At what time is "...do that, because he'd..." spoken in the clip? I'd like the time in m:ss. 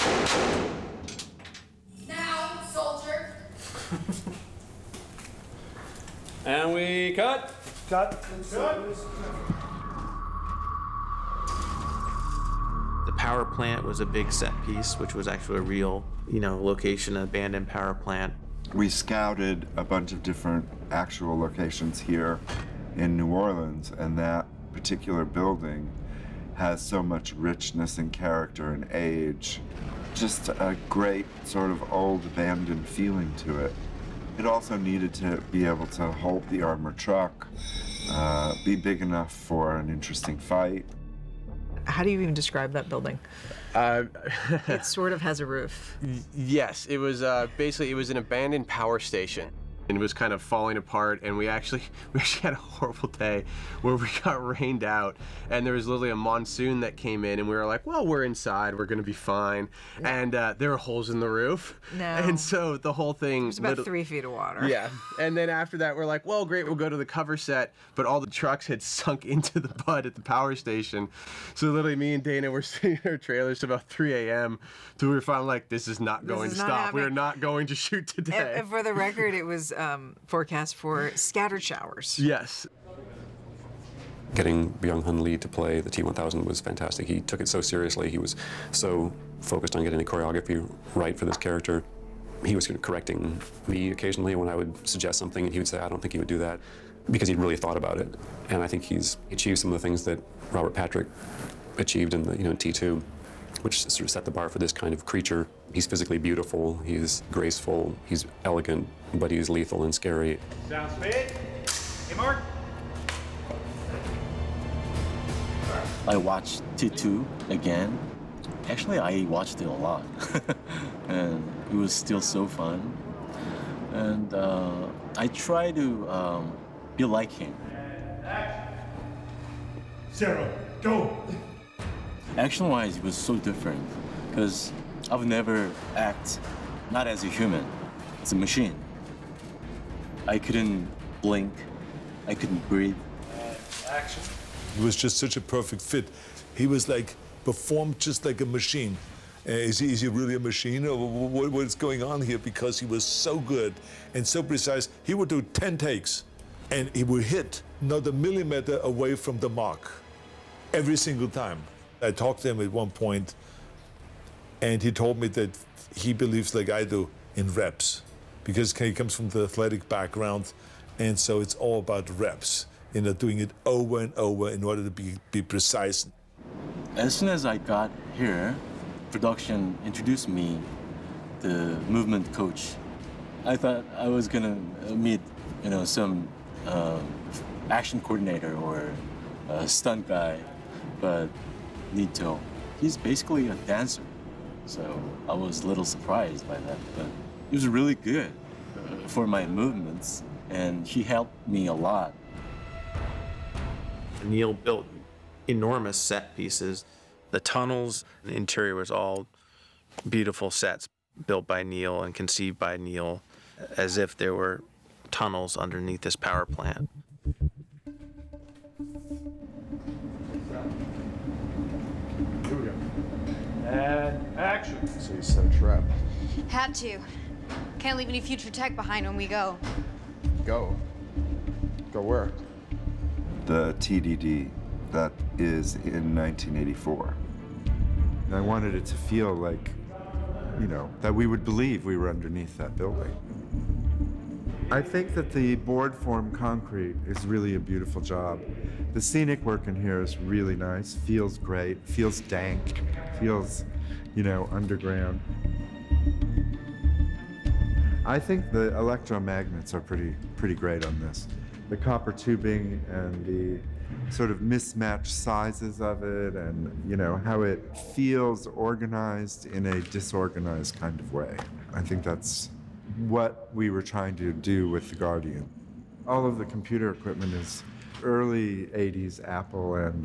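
1:36.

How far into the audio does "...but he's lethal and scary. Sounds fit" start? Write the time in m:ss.
1:49.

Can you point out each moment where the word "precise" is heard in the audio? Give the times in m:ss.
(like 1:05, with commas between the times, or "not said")
2:34, 2:55.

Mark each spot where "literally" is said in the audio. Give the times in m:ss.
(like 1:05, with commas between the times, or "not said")
0:55, 1:11.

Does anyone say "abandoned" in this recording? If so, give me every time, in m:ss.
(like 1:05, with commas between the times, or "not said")
0:17, 0:32, 0:48.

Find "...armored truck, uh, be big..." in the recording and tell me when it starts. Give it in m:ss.
0:36.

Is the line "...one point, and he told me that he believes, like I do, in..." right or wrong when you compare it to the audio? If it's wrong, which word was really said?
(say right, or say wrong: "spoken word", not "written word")
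right.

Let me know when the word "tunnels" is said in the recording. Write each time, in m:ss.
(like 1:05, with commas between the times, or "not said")
3:27, 3:35.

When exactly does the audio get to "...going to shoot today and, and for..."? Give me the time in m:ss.
1:17.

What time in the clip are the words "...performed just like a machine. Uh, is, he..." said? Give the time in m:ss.
2:27.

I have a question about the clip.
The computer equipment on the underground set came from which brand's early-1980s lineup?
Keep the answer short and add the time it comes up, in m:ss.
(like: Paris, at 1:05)
Apple, at 4:39.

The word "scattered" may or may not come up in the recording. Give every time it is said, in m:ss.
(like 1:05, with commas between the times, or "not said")
1:21.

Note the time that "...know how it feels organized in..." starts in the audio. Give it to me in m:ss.
4:26.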